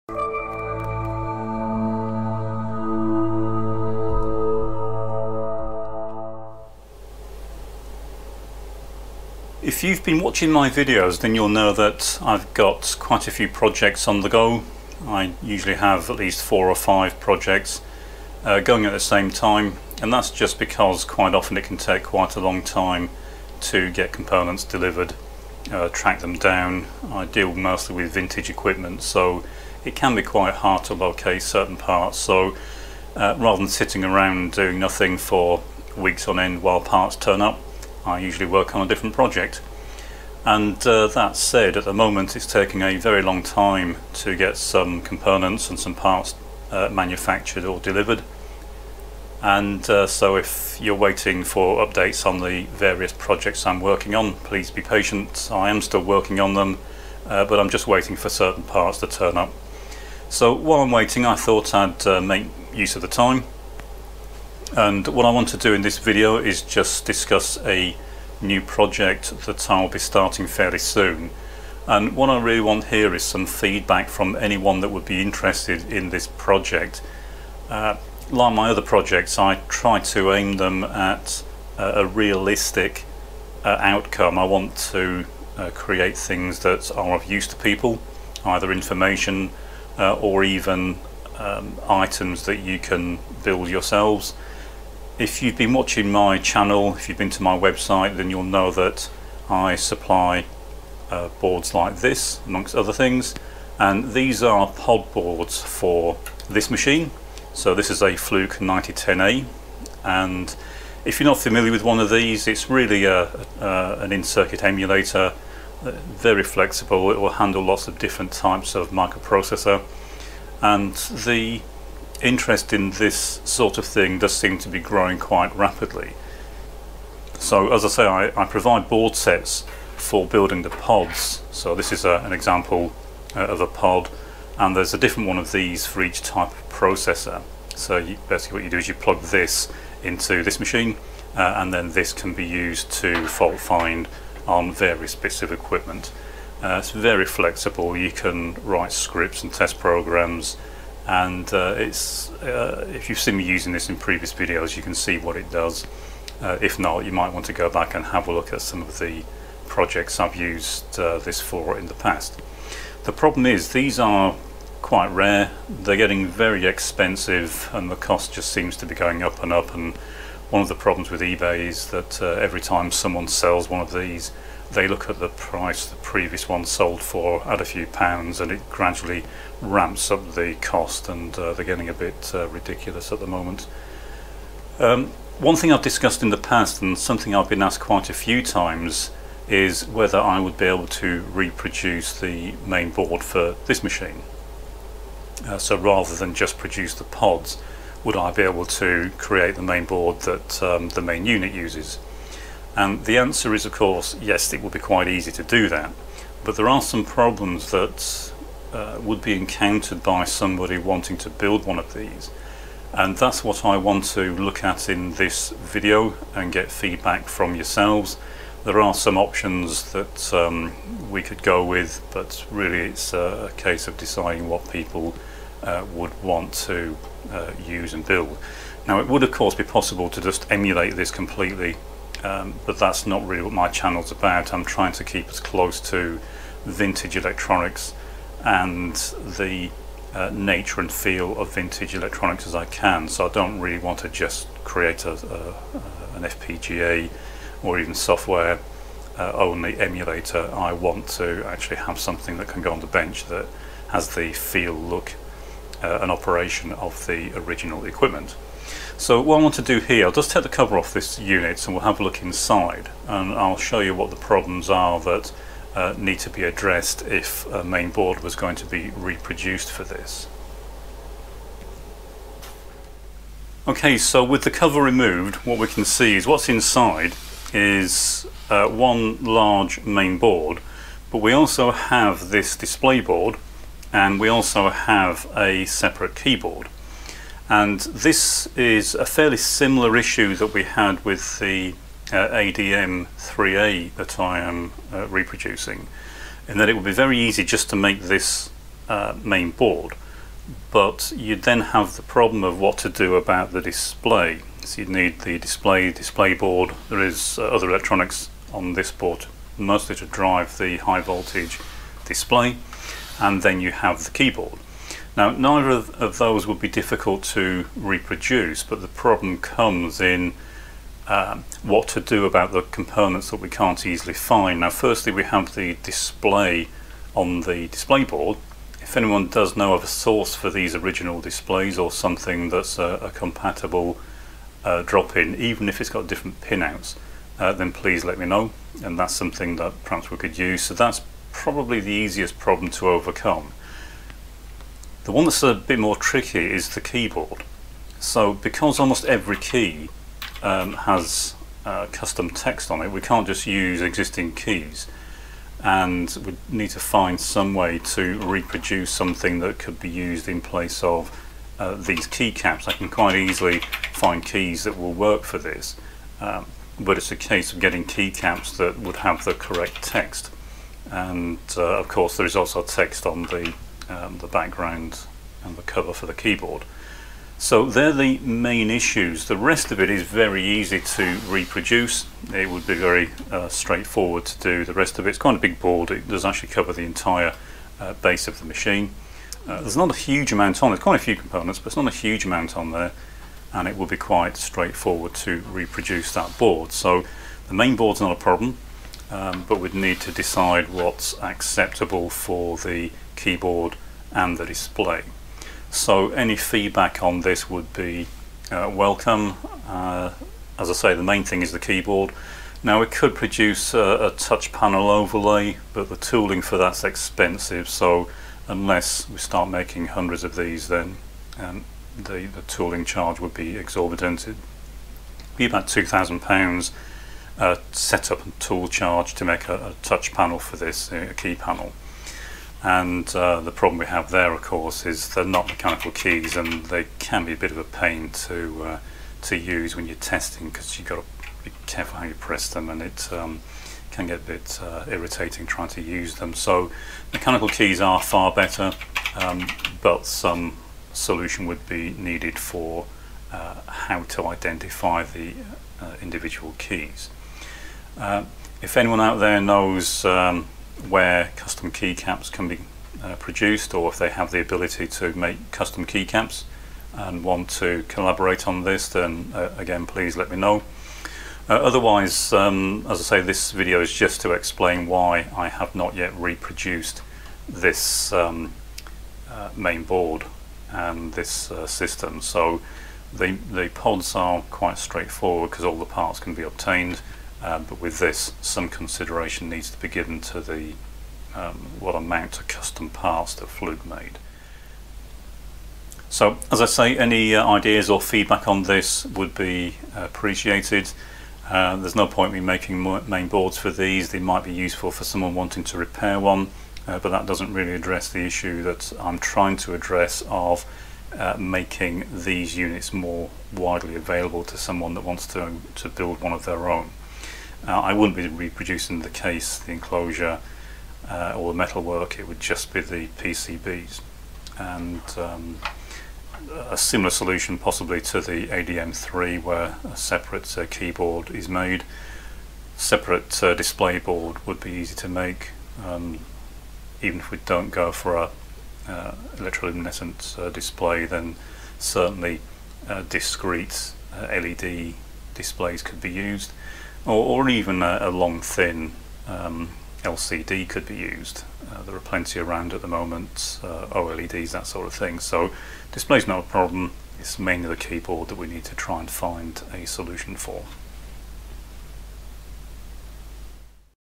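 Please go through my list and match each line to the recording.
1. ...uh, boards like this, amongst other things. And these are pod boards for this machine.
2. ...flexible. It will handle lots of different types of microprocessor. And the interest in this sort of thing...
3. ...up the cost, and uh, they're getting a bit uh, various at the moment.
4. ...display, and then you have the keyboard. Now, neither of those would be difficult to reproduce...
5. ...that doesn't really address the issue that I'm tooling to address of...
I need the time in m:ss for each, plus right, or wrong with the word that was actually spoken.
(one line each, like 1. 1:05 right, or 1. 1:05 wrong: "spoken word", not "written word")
1. 1:41 right
2. 1:56 right
3. 3:00 wrong: "ridiculous", not "various"
4. 5:12 right
5. 8:27 wrong: "trying", not "tooling".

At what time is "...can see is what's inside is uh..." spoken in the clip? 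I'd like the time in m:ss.
4:35.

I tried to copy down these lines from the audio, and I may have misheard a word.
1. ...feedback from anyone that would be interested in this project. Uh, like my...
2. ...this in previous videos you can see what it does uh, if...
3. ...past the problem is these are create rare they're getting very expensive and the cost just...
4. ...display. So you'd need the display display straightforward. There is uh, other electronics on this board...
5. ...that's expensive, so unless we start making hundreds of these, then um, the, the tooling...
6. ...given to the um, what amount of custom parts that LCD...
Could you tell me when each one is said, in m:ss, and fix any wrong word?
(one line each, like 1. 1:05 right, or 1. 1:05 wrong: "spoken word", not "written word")
1. 1:13 right
2. 2:33 right
3. 2:41 wrong: "quite", not "create"
4. 5:03 wrong: "board", not "straightforward"
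5. 6:56 right
6. 8:09 wrong: "Fluke", not "LCD".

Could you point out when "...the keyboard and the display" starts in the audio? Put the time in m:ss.
6:42.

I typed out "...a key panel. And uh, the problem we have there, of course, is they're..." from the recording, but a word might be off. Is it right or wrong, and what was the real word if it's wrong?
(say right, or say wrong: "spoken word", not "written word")
right.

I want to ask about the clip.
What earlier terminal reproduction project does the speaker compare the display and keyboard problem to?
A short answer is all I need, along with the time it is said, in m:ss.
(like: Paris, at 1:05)
ADM 3A, at 4:52.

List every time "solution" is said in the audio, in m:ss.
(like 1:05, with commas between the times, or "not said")
7:30, 8:47, 9:19.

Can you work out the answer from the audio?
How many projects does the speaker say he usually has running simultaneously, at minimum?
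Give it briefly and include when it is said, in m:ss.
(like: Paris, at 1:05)
4 or 5, at 0:16.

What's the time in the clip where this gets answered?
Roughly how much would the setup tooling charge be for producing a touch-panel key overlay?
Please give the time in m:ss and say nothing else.
7:05.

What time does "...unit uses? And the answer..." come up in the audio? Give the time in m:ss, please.
3:21.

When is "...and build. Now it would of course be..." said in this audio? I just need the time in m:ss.
3:47.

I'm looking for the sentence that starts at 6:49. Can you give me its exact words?
Uh, as I say, the main thing is the keyboard.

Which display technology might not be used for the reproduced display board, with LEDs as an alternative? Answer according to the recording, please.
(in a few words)
electroluminescent.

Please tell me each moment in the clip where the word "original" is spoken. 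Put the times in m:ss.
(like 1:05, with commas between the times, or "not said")
4:17, 5:30.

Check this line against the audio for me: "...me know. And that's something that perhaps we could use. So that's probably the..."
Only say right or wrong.
right.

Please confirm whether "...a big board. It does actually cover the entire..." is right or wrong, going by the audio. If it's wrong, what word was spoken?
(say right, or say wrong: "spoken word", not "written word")
right.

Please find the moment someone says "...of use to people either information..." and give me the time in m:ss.
1:27.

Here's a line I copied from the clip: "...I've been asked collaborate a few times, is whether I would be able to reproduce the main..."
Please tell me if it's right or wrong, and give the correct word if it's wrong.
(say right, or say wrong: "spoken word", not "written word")
wrong: "quite", not "collaborate".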